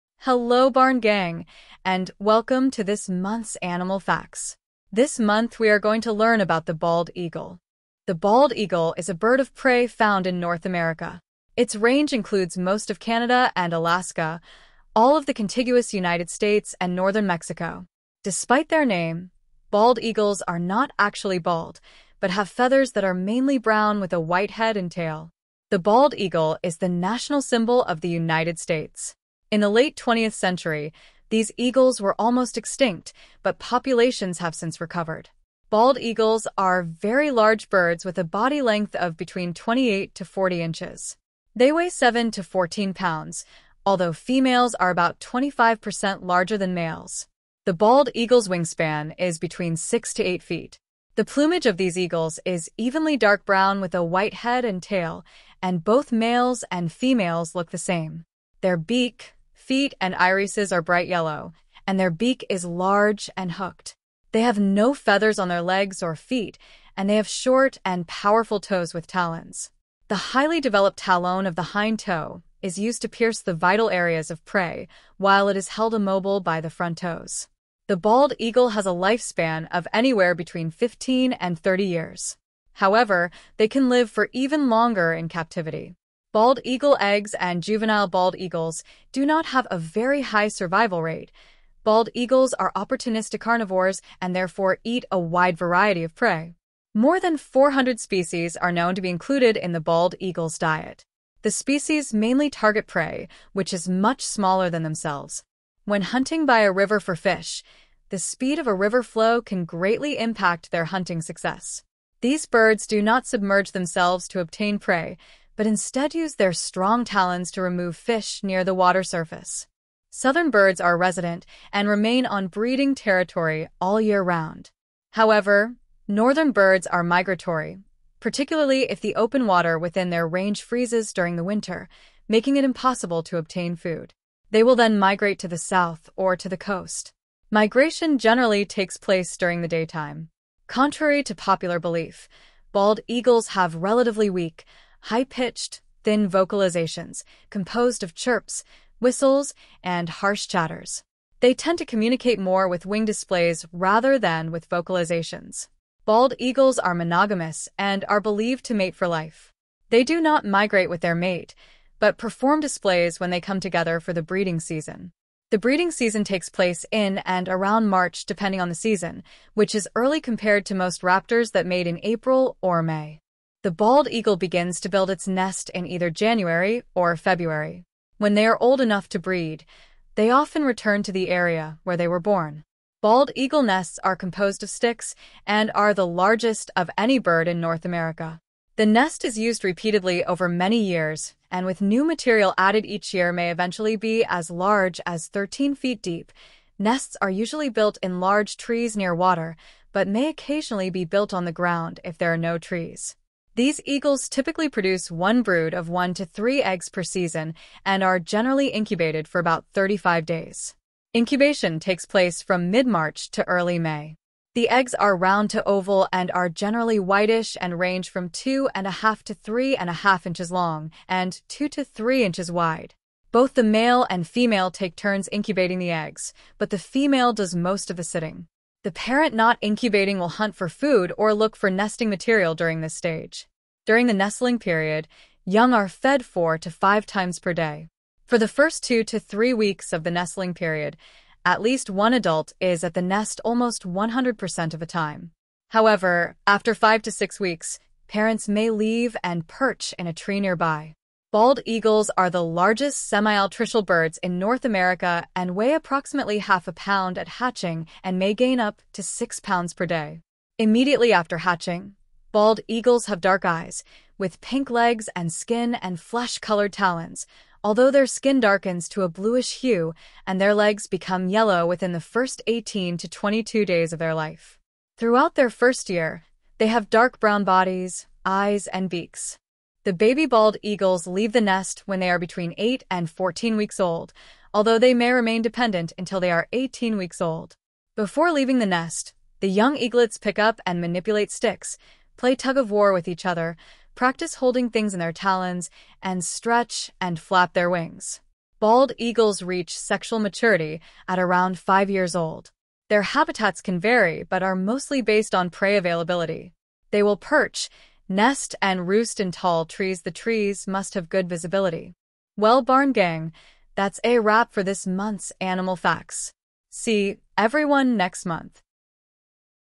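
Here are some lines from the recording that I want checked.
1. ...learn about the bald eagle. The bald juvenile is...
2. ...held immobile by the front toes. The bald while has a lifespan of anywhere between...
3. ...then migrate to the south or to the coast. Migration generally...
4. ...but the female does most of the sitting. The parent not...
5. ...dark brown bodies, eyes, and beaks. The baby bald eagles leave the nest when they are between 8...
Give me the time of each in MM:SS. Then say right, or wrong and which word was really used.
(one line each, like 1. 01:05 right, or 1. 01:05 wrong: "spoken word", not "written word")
1. 00:06 wrong: "eagle", not "juvenile"
2. 01:15 wrong: "eagle", not "while"
3. 02:14 right
4. 03:46 right
5. 04:36 right.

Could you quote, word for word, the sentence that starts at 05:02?
Their habitats can vary, but are mostly based on prey availability.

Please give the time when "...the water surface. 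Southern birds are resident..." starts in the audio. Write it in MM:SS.
01:58.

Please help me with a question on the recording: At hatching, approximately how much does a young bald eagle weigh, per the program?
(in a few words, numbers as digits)
Half a pound.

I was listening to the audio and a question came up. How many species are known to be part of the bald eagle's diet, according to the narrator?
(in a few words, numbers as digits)
More than 400.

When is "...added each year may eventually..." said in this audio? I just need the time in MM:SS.
03:12.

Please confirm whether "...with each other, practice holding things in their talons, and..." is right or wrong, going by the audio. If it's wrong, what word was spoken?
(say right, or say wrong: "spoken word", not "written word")
right.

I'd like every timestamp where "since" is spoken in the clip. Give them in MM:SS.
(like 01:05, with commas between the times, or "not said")
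00:34.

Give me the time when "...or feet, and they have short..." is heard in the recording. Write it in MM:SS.
01:06.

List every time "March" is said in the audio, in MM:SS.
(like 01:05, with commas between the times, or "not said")
02:47, 03:32.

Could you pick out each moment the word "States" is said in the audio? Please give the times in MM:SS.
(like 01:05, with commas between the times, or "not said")
00:16, 00:28.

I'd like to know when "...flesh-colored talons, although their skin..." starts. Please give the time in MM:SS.
04:25.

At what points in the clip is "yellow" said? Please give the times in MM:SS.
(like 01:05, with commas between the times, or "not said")
01:01, 04:31.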